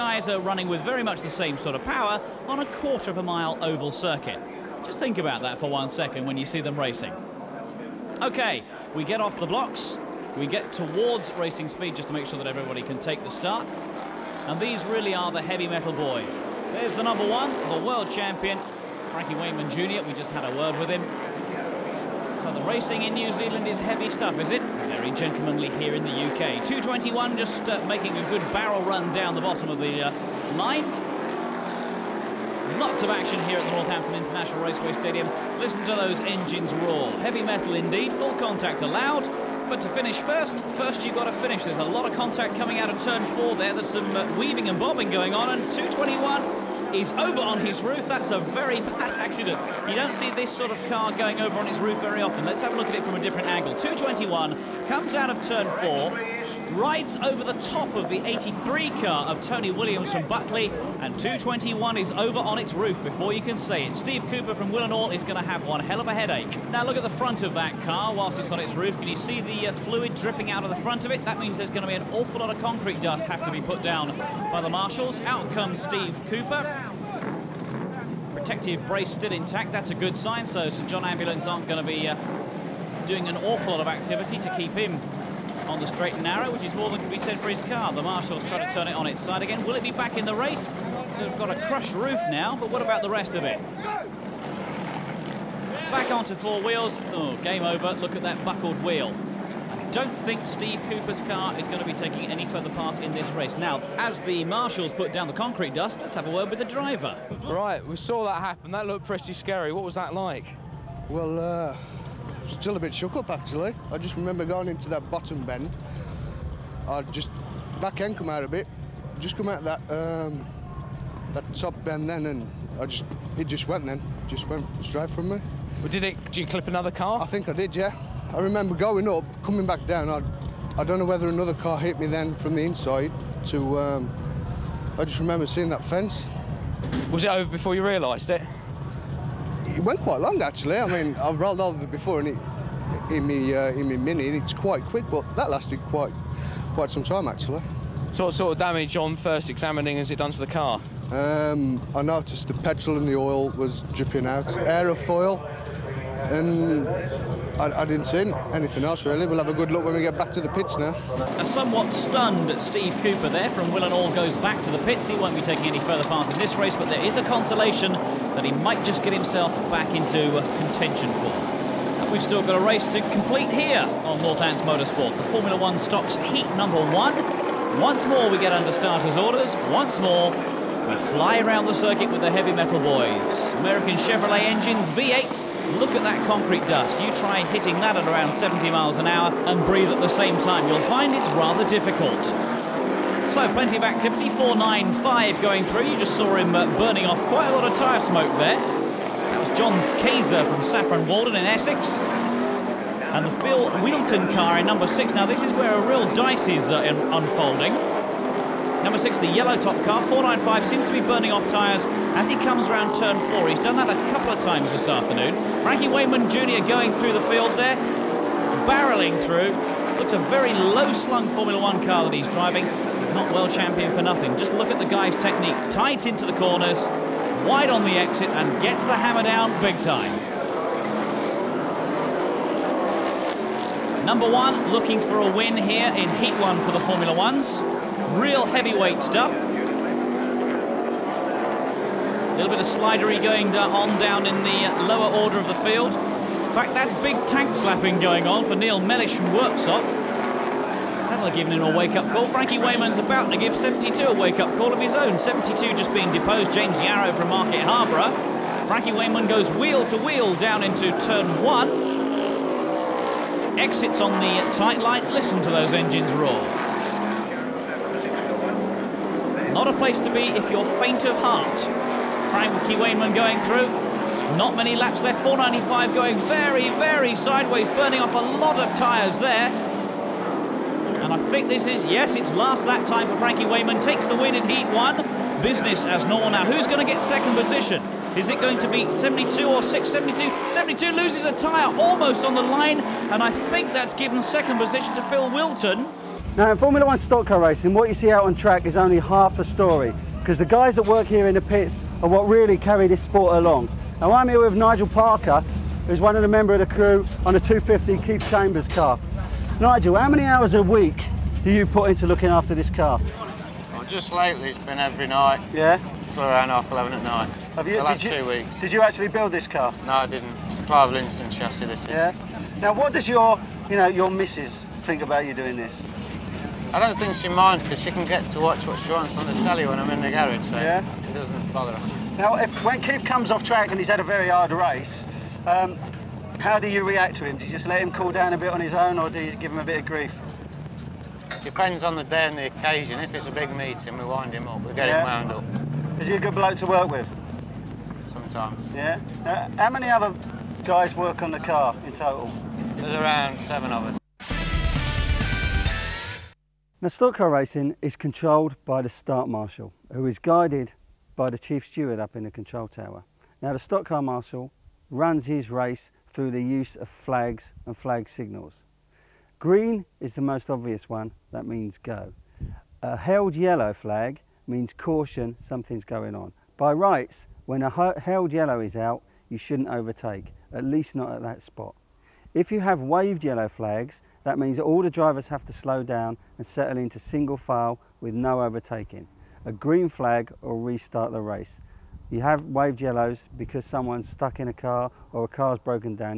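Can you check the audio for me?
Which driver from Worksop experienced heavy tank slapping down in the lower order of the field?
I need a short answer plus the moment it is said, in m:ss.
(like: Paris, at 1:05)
Neil Mellish, at 4:08.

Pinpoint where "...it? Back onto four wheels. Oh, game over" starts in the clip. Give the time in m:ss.
1:33.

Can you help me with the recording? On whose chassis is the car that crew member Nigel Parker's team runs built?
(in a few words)
Clive Linson.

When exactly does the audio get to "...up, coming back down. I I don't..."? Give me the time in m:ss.
2:09.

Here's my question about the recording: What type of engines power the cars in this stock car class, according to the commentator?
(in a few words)
American Chevrolet V8.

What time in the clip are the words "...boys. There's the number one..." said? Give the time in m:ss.
0:15.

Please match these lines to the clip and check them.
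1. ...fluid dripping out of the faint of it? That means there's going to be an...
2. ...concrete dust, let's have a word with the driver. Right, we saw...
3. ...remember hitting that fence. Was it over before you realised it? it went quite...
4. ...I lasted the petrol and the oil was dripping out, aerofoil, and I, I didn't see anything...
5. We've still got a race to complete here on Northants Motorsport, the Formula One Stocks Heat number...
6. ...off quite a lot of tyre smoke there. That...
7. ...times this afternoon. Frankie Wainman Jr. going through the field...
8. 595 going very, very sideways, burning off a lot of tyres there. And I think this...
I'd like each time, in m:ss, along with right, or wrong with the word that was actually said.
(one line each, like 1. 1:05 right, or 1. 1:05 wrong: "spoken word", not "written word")
1. 1:09 wrong: "front", not "faint"
2. 1:45 right
3. 2:15 wrong: "seeing", not "hitting"
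4. 2:31 wrong: "noticed", not "lasted"
5. 2:52 right
6. 3:17 right
7. 3:34 right
8. 4:35 wrong: "495", not "595".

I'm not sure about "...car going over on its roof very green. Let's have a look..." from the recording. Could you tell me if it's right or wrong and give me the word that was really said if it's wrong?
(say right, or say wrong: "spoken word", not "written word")
wrong: "often", not "green".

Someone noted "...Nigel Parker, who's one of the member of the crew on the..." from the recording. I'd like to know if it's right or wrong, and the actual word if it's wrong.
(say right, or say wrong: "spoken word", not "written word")
right.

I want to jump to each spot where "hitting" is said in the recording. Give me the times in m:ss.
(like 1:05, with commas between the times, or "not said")
3:07.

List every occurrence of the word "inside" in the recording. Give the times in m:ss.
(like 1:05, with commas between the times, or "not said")
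2:12.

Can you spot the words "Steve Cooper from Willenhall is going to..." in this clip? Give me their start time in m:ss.
1:03.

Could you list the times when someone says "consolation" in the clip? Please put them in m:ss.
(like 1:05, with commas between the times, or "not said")
2:47.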